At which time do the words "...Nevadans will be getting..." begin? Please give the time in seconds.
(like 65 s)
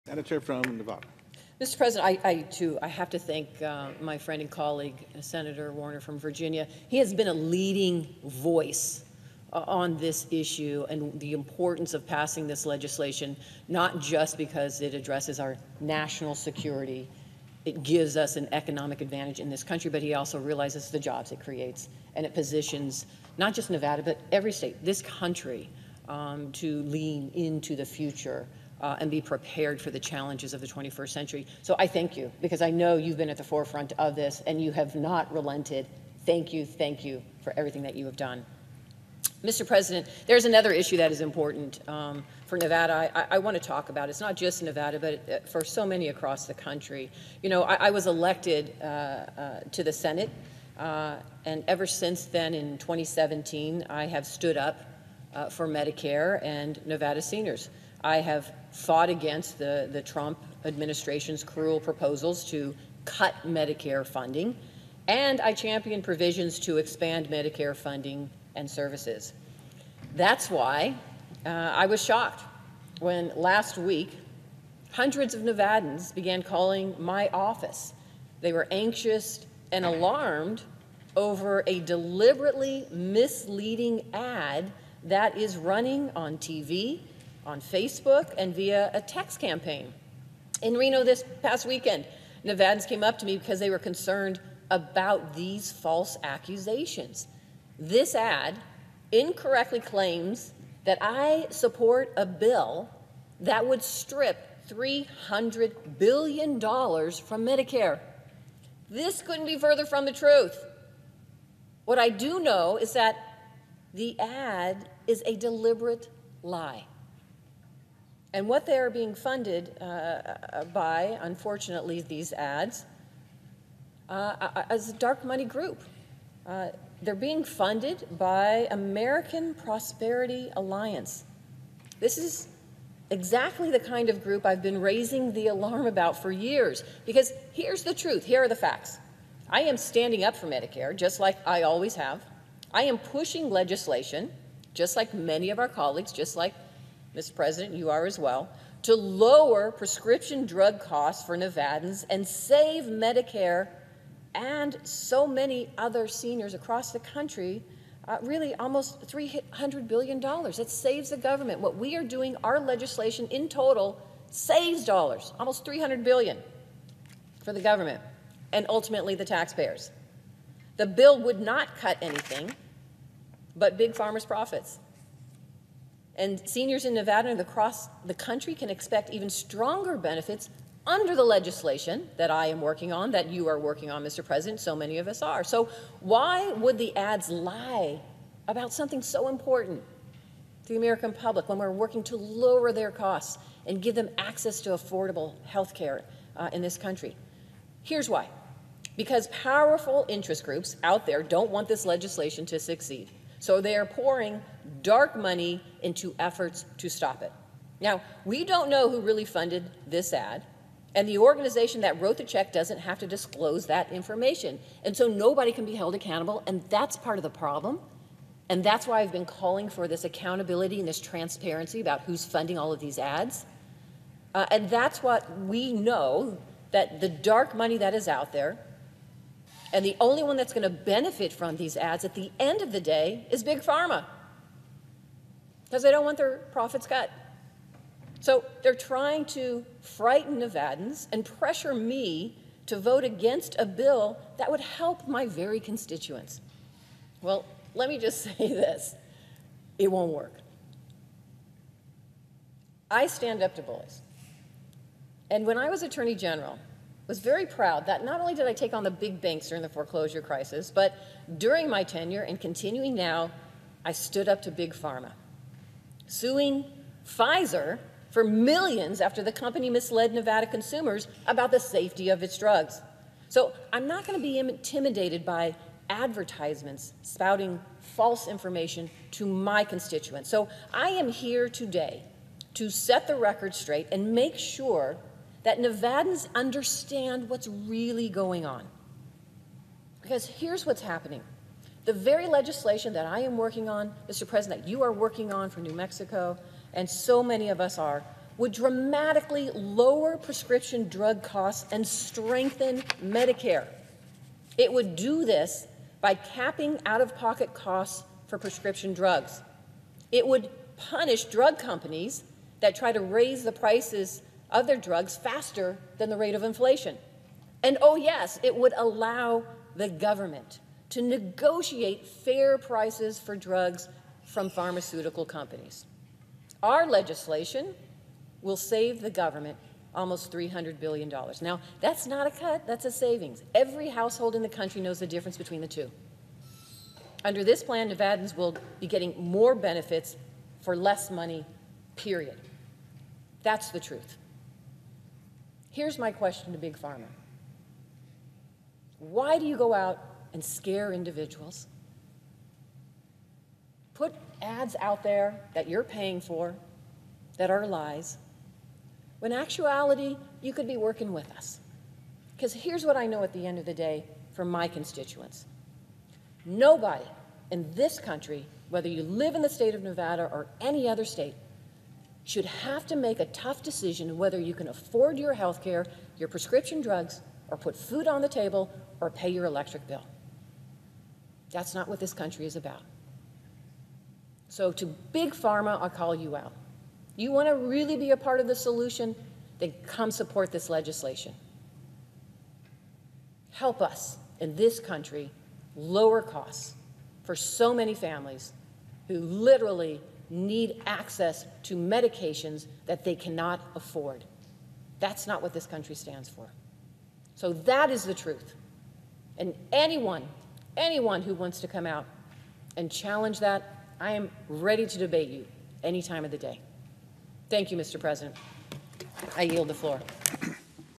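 337 s.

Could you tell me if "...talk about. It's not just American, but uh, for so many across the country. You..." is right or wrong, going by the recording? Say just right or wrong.
wrong.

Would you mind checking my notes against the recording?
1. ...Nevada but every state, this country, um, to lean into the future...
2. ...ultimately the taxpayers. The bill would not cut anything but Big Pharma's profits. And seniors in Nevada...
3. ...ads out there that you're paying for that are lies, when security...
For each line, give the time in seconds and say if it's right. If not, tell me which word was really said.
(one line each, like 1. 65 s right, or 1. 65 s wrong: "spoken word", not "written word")
1. 23 s right
2. 168 s right
3. 354 s wrong: "actuality", not "security".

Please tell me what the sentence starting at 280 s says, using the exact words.
So I am here today to set the record straight and make sure that Nevadans understand what's really going on.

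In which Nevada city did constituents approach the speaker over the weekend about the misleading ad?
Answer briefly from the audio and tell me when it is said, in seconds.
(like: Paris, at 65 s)
Reno, at 90 s.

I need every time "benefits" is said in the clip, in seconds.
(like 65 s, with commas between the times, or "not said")
179 s, 230 s, 339 s.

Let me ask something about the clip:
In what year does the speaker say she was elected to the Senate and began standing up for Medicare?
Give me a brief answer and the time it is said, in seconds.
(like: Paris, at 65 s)
2017, at 52 s.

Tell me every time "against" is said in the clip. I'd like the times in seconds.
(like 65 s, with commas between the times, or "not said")
59 s, 243 s.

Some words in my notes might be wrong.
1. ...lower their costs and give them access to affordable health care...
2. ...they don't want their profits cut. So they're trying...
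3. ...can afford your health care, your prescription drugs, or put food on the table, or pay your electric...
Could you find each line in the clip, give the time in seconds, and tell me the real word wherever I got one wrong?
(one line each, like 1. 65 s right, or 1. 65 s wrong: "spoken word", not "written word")
1. 192 s right
2. 235 s right
3. 374 s right.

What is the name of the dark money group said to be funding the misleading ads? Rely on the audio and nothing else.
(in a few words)
American Prosperity Alliance.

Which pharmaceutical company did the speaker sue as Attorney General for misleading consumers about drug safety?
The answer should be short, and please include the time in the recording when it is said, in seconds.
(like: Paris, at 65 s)
Pfizer, at 267 s.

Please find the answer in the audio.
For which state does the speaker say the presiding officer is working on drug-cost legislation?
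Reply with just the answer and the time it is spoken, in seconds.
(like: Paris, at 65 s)
New Mexico, at 295 s.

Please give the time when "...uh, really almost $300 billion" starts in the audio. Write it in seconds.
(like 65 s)
158 s.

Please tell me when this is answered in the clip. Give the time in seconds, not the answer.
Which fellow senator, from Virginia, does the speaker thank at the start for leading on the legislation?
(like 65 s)
5 s.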